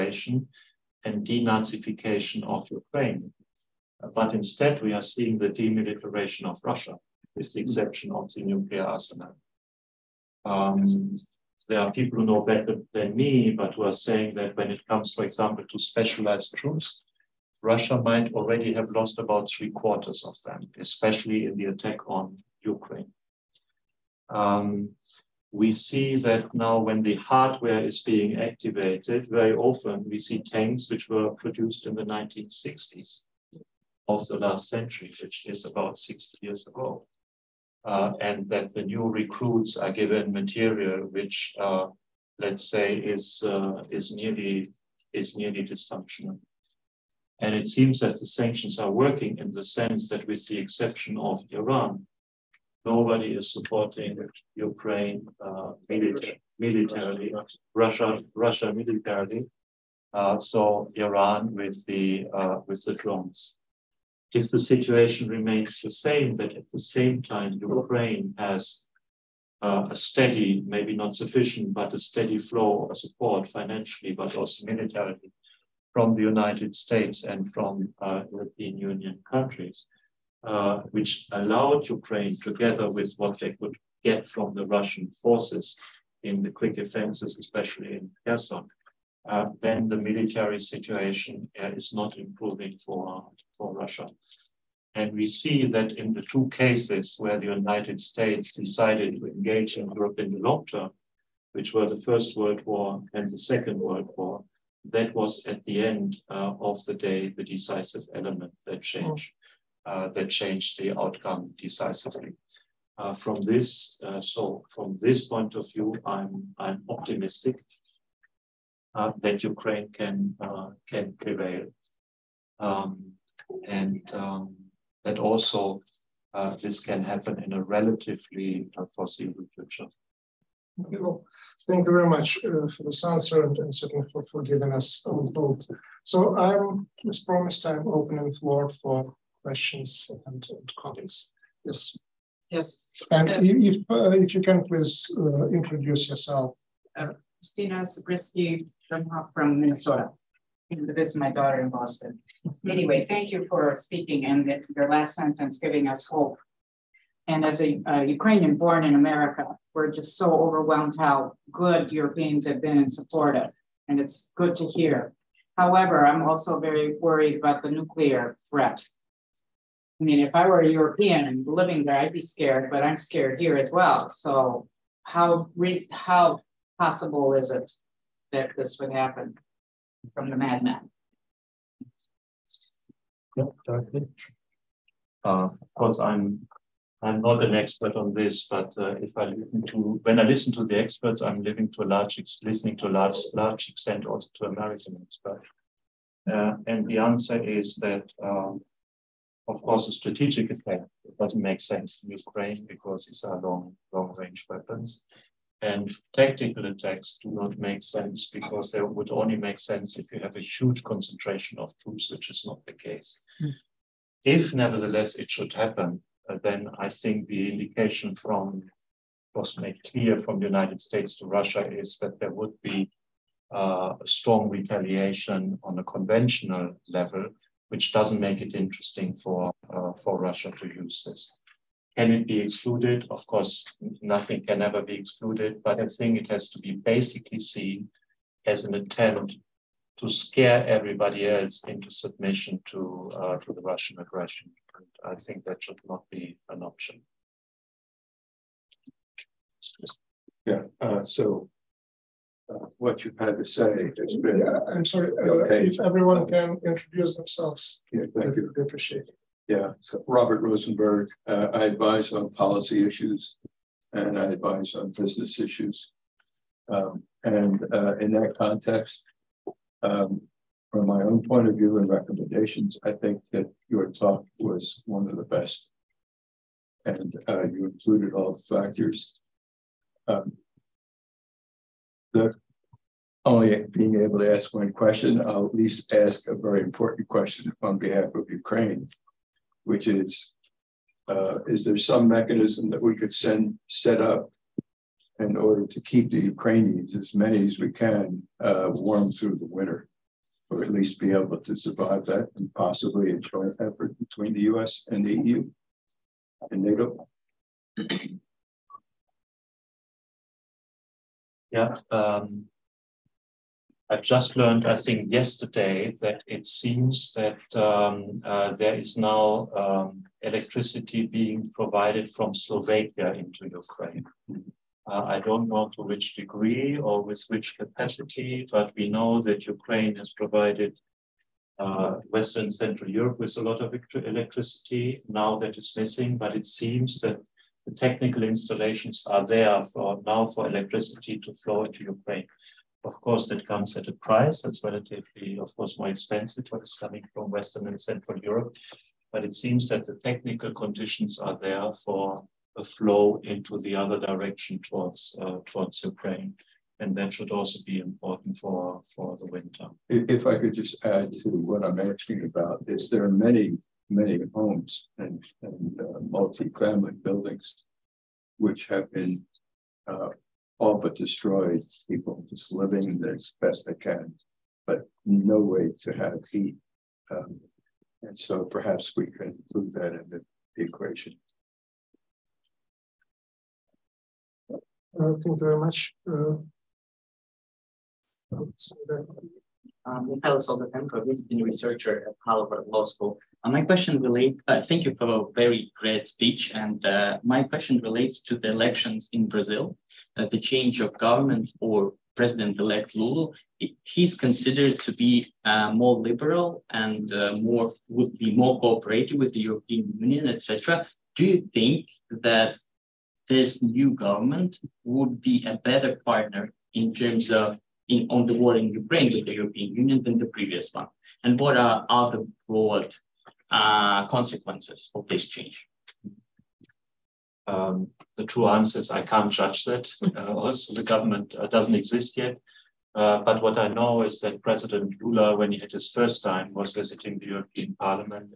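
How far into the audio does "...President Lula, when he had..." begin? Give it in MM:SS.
07:14.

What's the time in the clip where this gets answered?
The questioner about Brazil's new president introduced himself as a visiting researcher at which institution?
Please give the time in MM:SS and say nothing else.
06:32.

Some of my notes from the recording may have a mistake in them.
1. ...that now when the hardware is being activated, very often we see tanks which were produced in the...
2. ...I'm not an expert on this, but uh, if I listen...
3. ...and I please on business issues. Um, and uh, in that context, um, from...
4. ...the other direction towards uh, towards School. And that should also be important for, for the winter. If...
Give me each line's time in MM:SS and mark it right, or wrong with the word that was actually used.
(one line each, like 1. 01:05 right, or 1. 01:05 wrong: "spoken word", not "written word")
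1. 00:26 right
2. 03:07 right
3. 04:23 wrong: "advise", not "please"
4. 05:53 wrong: "Ukraine", not "School".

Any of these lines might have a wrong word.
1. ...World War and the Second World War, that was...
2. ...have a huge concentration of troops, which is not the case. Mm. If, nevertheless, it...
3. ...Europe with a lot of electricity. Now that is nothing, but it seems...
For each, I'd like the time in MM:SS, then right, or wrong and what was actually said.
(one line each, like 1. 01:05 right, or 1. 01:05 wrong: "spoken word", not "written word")
1. 01:42 right
2. 03:30 right
3. 05:32 wrong: "missing", not "nothing".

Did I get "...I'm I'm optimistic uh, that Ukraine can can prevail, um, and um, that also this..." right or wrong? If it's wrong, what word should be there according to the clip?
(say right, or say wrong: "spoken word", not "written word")
right.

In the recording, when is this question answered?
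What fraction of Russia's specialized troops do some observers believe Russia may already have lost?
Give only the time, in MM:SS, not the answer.
00:19.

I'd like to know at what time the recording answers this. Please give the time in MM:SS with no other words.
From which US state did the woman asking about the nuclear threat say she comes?
02:29.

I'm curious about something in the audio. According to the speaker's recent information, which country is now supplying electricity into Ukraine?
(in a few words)
Slovakia.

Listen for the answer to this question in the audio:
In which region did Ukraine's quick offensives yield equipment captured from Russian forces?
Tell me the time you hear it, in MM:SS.
01:28.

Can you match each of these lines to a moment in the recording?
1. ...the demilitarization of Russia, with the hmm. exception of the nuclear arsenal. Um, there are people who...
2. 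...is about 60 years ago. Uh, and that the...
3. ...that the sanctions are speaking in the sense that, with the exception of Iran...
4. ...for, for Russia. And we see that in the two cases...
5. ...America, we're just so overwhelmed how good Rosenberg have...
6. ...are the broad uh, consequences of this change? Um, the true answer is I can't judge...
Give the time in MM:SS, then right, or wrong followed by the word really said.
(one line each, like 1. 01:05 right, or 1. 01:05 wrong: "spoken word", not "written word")
1. 00:05 right
2. 00:35 right
3. 00:47 wrong: "working", not "speaking"
4. 01:32 right
5. 02:38 wrong: "Europeans", not "Rosenberg"
6. 07:01 right.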